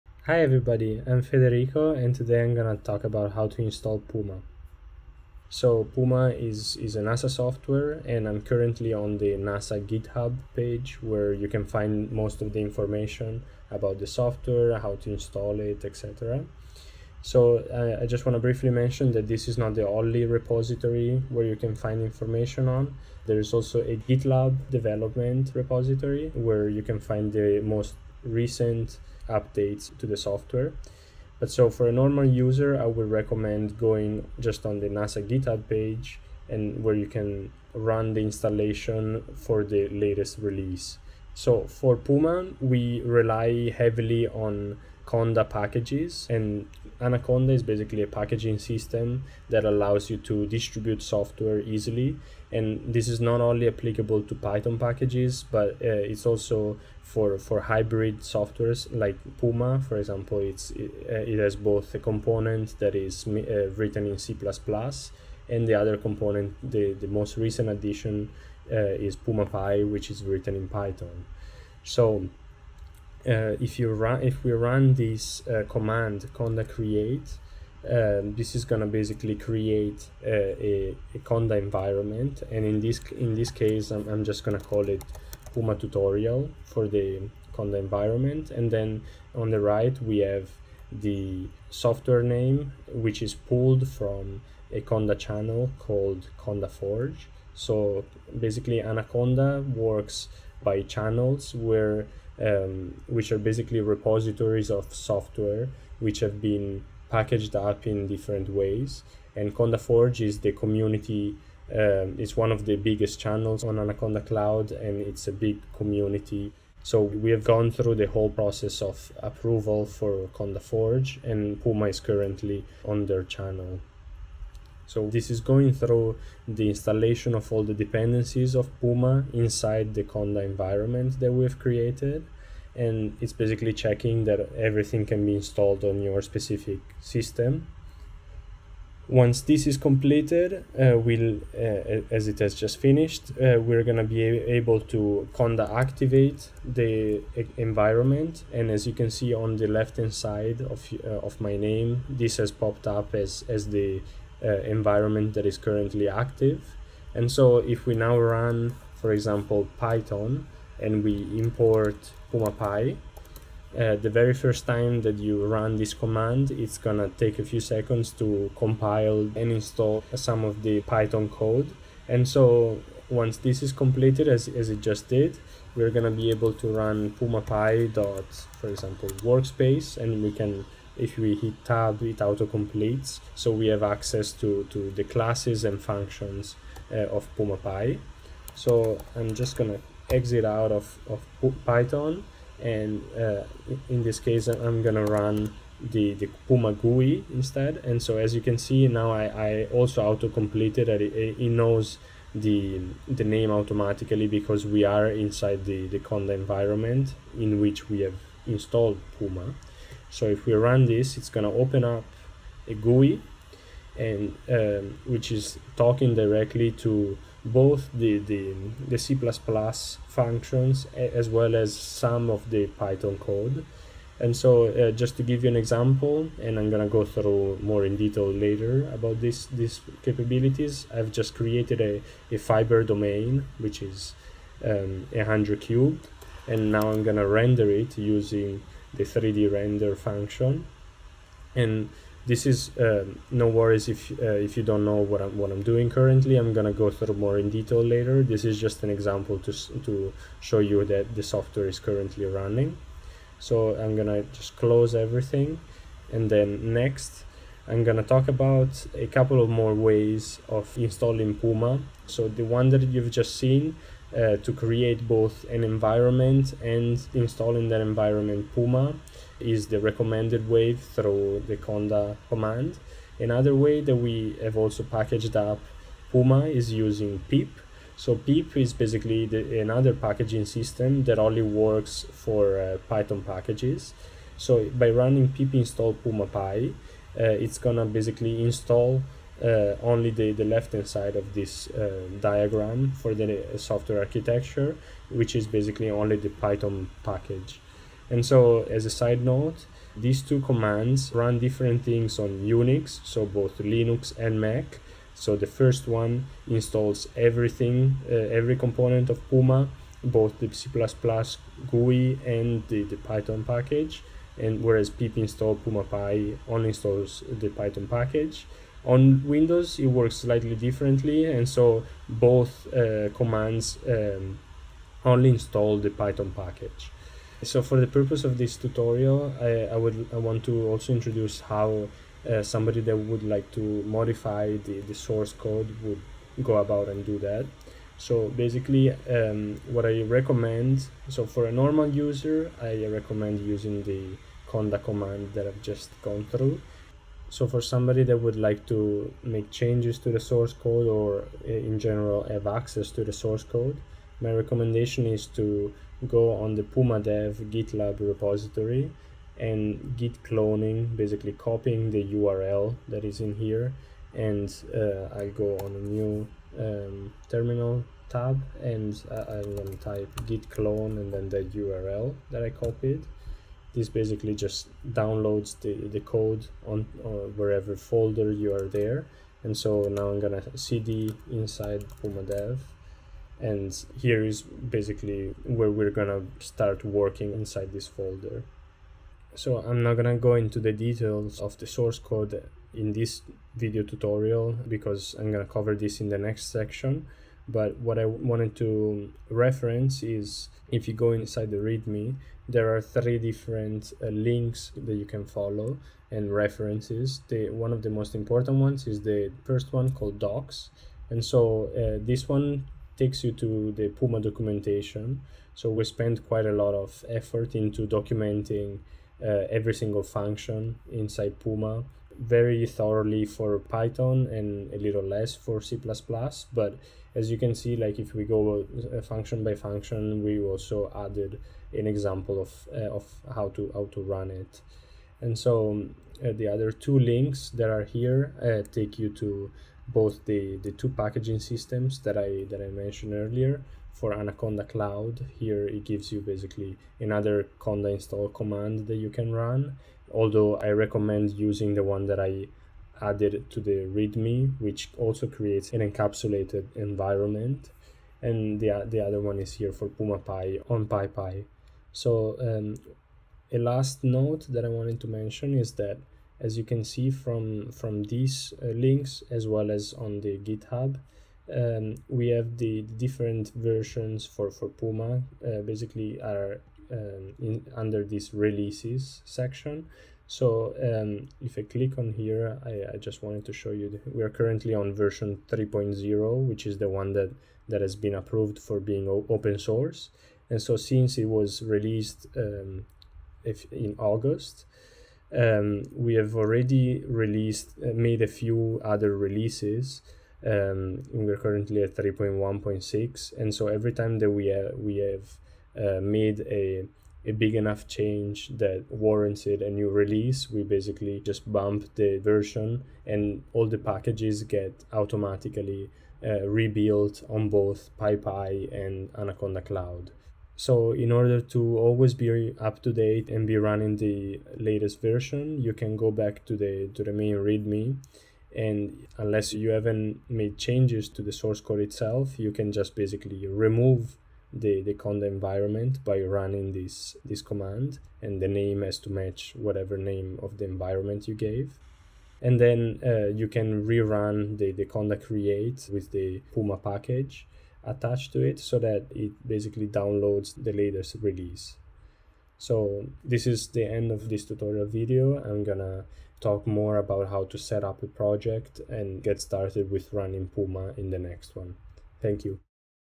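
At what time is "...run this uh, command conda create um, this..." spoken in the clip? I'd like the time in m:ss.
1:14.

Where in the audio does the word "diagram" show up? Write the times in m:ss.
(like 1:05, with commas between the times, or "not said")
4:52.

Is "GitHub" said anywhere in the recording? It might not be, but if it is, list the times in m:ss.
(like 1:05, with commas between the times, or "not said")
0:09, 0:35, 7:50.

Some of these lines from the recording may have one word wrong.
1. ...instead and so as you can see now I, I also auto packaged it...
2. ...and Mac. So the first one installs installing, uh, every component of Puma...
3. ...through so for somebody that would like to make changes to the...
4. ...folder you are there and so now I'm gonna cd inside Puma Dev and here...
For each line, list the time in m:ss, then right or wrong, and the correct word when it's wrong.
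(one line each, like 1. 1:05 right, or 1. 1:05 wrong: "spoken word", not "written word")
1. 3:17 wrong: "completed", not "packaged"
2. 5:04 wrong: "everything", not "installing"
3. 5:46 right
4. 6:17 right.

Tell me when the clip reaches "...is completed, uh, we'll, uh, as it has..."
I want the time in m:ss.
2:19.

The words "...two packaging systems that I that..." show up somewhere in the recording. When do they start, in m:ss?
7:20.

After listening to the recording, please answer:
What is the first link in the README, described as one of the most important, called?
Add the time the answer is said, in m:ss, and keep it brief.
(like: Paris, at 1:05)
Docs, at 6:50.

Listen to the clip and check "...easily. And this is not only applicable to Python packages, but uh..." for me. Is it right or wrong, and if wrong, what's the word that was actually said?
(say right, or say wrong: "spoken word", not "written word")
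right.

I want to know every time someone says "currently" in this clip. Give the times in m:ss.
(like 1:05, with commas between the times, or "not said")
0:08, 2:01, 2:35, 4:05, 4:11, 8:04, 8:21.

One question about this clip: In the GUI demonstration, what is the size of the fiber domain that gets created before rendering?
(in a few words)
100 cubed.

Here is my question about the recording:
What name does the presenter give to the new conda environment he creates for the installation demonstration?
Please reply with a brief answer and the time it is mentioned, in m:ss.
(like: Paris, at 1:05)
puma tutorial, at 1:25.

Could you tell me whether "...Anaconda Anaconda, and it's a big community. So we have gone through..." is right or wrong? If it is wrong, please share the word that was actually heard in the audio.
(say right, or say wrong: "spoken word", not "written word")
wrong: "Cloud", not "Anaconda".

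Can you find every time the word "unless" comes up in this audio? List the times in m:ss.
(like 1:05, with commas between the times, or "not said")
8:49.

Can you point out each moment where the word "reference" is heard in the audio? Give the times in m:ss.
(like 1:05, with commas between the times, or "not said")
6:39, 6:46.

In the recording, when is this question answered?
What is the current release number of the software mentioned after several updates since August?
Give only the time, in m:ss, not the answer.
8:21.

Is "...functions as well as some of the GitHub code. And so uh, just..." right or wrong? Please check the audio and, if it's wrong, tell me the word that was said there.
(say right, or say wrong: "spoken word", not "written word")
wrong: "Python", not "GitHub".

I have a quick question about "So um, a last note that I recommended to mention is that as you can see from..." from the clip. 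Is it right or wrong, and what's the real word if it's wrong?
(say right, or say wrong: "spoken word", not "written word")
wrong: "wanted", not "recommended".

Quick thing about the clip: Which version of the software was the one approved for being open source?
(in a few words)
3.0.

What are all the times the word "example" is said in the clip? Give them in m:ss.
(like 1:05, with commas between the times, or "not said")
0:59, 2:39, 2:58, 3:45, 4:08, 7:11.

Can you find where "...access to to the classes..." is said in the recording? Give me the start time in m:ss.
3:03.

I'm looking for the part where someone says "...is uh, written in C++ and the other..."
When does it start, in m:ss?
1:02.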